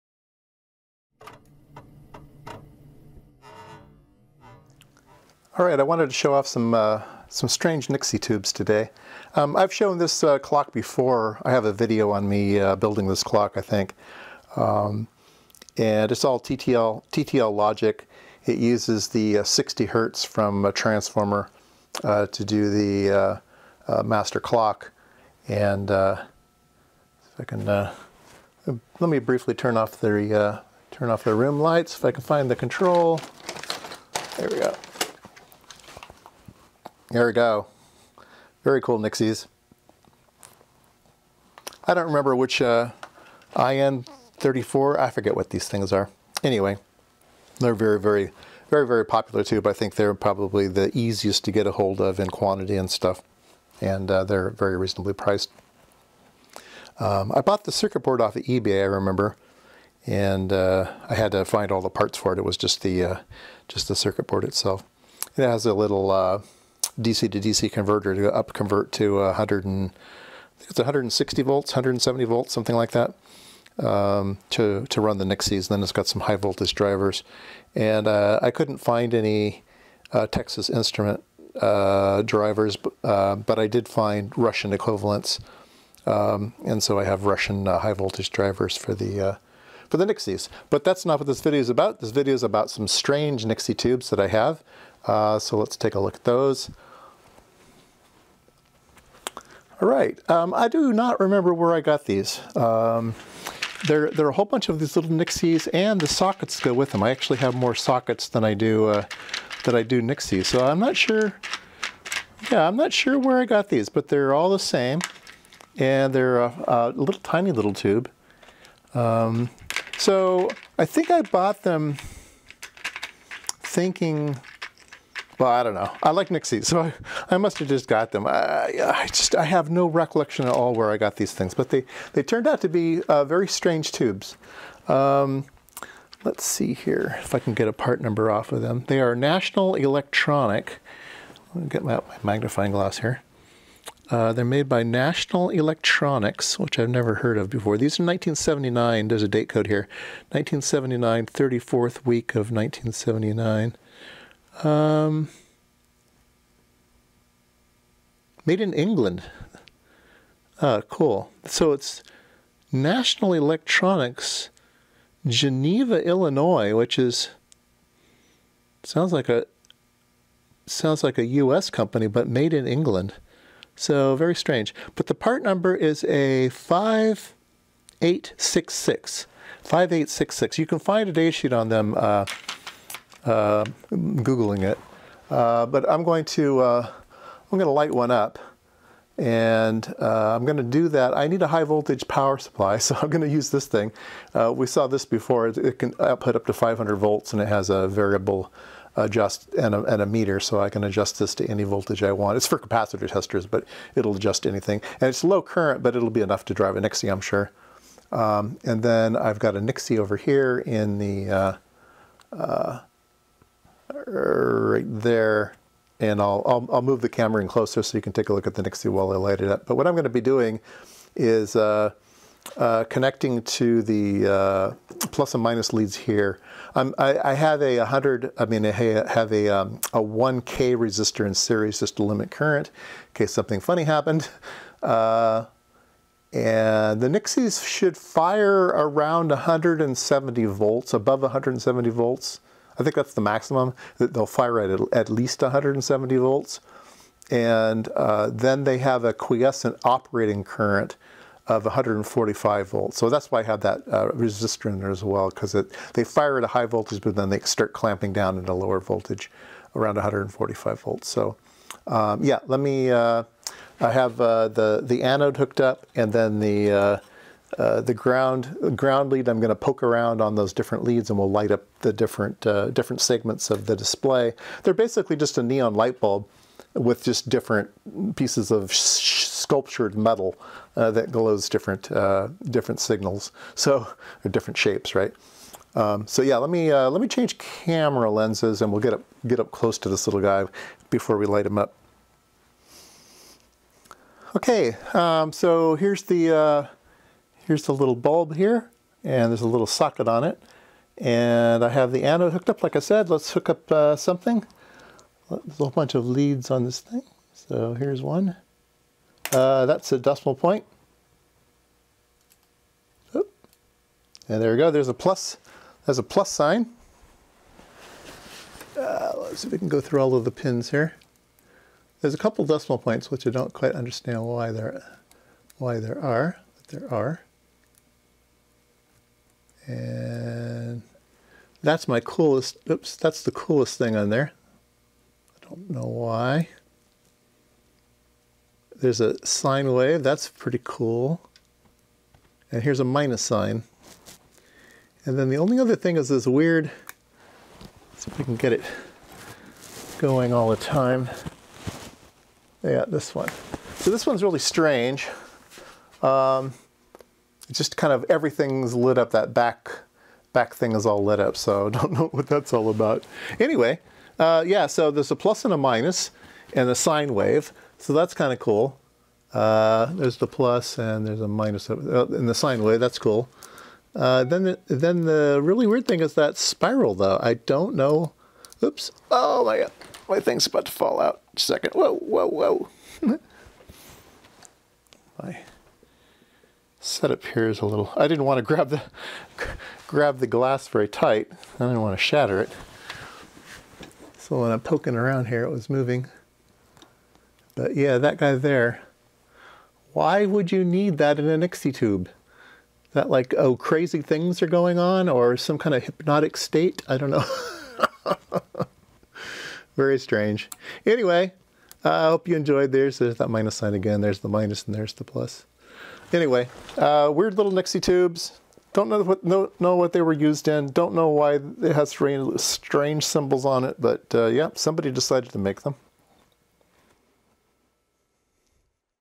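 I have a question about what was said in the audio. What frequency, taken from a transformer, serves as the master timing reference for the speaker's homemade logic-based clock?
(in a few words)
60 hertz.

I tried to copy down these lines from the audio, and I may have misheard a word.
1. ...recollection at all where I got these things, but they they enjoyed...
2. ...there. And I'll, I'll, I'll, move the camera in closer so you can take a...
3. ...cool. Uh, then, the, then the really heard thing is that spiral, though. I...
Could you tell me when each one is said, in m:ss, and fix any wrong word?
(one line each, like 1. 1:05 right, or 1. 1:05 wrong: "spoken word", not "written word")
1. 2:09 wrong: "turned", not "enjoyed"
2. 3:34 right
3. 6:12 wrong: "weird", not "heard".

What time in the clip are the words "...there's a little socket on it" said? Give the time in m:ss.
4:59.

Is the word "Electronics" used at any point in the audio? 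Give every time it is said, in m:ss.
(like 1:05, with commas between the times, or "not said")
2:19, 2:25, 2:43.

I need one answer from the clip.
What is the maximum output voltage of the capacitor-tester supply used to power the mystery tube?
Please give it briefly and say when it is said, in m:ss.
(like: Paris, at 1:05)
500 volts, at 3:16.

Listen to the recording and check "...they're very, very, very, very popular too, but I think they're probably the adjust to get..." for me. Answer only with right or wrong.
wrong.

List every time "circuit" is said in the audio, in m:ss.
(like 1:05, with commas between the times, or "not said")
0:57, 1:03.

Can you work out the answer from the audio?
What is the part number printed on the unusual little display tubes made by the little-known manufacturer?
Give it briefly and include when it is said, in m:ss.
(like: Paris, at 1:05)
5866, at 2:59.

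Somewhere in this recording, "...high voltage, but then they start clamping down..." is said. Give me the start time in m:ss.
4:16.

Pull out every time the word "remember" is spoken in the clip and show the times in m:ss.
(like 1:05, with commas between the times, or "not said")
0:42, 0:58, 1:41.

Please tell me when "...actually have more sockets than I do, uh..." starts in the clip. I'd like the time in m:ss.
1:47.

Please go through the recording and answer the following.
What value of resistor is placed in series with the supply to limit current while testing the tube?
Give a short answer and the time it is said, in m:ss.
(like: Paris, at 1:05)
1K, at 3:49.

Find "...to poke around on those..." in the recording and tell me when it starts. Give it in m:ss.
4:29.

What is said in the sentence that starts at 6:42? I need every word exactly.
That like, oh, crazy things are going on or some kind of hypnotic state?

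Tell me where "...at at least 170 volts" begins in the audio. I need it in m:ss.
4:04.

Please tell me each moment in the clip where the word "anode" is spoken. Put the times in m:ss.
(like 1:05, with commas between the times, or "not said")
4:25, 5:02.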